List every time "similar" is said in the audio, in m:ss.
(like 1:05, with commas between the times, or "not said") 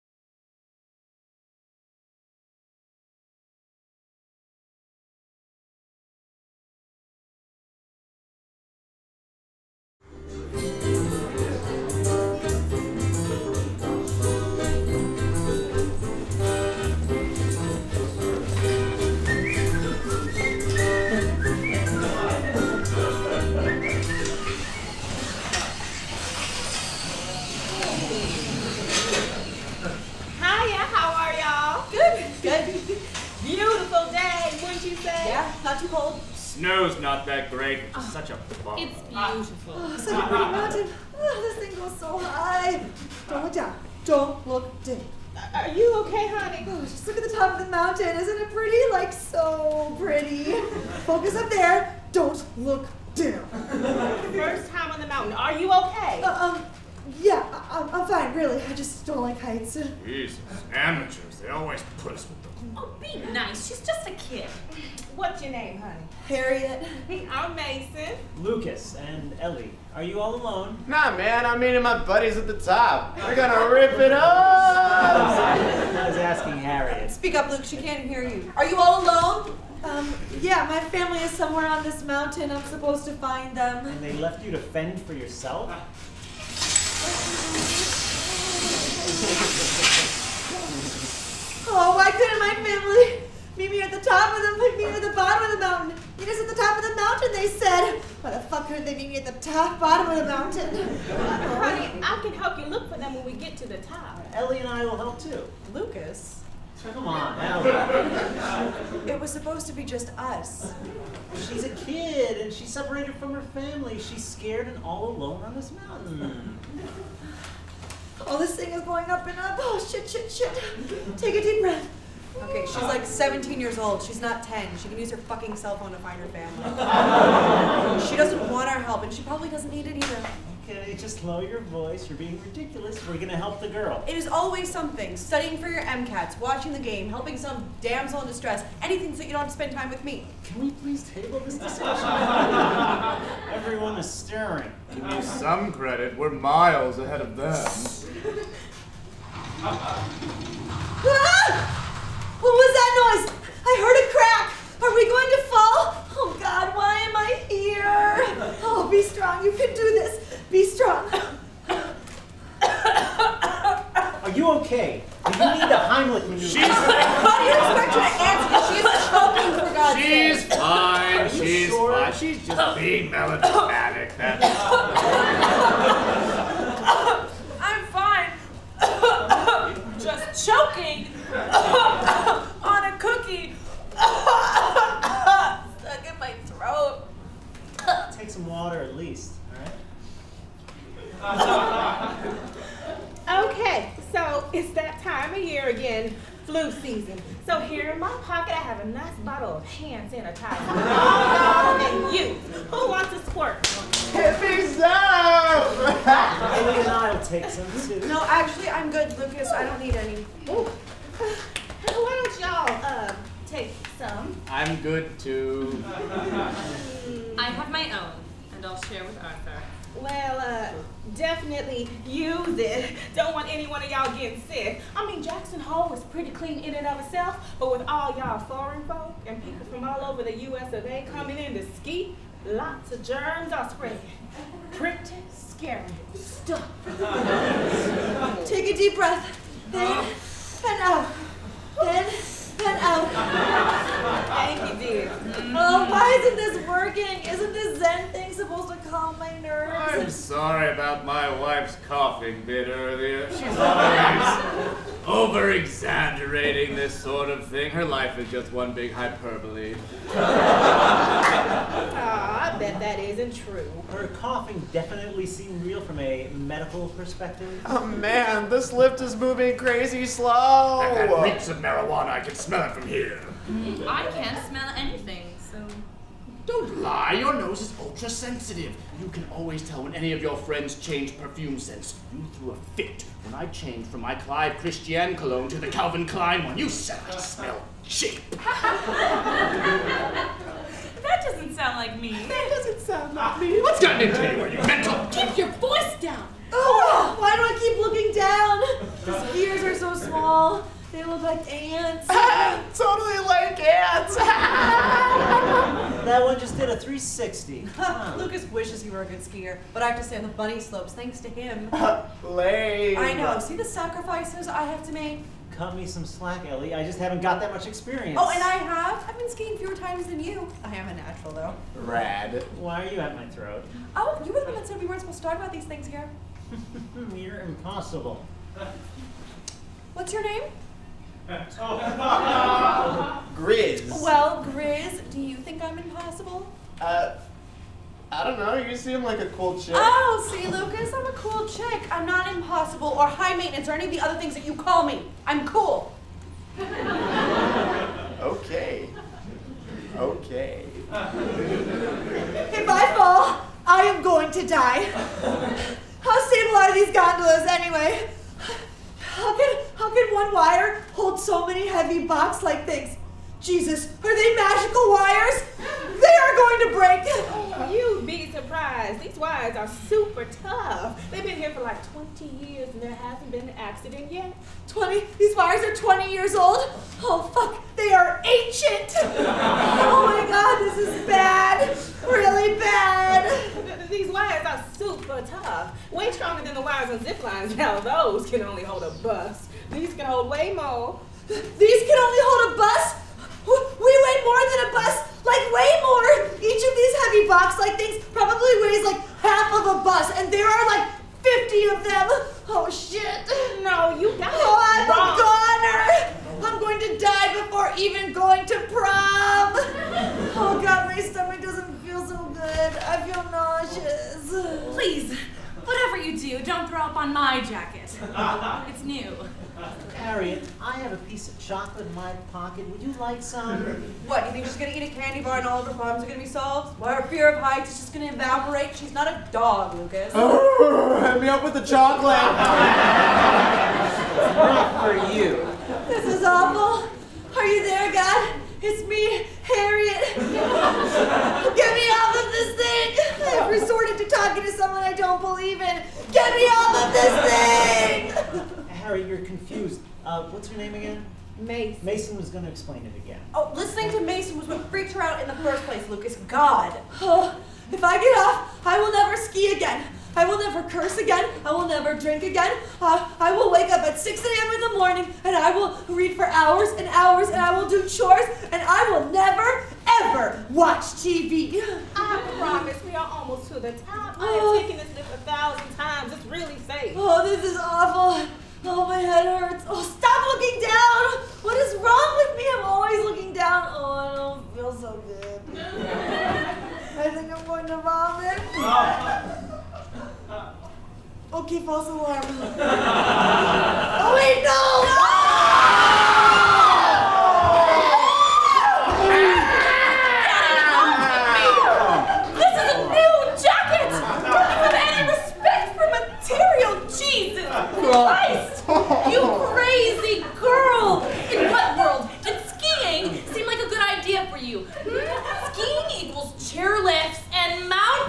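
not said.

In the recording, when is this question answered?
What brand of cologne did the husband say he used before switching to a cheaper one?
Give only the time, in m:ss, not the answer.
4:44.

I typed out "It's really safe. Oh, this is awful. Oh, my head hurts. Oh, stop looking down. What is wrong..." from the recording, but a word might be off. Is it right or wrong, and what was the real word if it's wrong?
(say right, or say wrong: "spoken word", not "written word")
right.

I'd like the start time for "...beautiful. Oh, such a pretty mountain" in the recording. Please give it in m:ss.
0:39.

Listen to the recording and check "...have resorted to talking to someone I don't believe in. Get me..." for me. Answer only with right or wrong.
right.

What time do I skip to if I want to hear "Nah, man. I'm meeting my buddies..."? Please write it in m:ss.
1:10.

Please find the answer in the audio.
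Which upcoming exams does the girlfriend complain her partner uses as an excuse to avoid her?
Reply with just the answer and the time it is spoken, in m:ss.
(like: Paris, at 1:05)
MCATs, at 2:15.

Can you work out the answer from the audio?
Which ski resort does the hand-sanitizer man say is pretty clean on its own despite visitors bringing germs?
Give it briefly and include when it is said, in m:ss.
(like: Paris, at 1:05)
Jackson Hole, at 3:45.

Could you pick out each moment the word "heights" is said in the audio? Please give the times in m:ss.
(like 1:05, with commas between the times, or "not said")
0:59, 7:07.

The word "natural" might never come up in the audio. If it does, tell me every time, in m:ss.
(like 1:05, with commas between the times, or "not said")
5:20.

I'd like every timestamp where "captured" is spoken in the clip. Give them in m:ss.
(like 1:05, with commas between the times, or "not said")
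not said.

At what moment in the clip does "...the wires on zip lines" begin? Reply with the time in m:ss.
6:26.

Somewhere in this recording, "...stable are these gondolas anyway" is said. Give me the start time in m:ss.
5:56.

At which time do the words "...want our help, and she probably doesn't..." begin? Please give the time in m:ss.
2:08.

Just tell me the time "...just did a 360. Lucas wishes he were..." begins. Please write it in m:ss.
5:06.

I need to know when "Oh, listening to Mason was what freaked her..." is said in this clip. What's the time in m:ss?
7:33.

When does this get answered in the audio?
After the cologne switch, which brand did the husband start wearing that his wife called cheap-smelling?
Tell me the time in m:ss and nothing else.
4:45.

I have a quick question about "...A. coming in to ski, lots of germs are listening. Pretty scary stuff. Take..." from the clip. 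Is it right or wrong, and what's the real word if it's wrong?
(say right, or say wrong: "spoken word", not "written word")
wrong: "spreading", not "listening".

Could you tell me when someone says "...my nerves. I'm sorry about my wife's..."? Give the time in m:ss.
4:09.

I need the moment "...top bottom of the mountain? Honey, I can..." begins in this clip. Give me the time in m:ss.
1:39.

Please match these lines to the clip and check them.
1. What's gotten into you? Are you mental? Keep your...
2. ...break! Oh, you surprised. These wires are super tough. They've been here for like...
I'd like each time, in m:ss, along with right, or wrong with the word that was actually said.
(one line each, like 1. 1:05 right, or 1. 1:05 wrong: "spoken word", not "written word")
1. 4:53 right
2. 6:06 right.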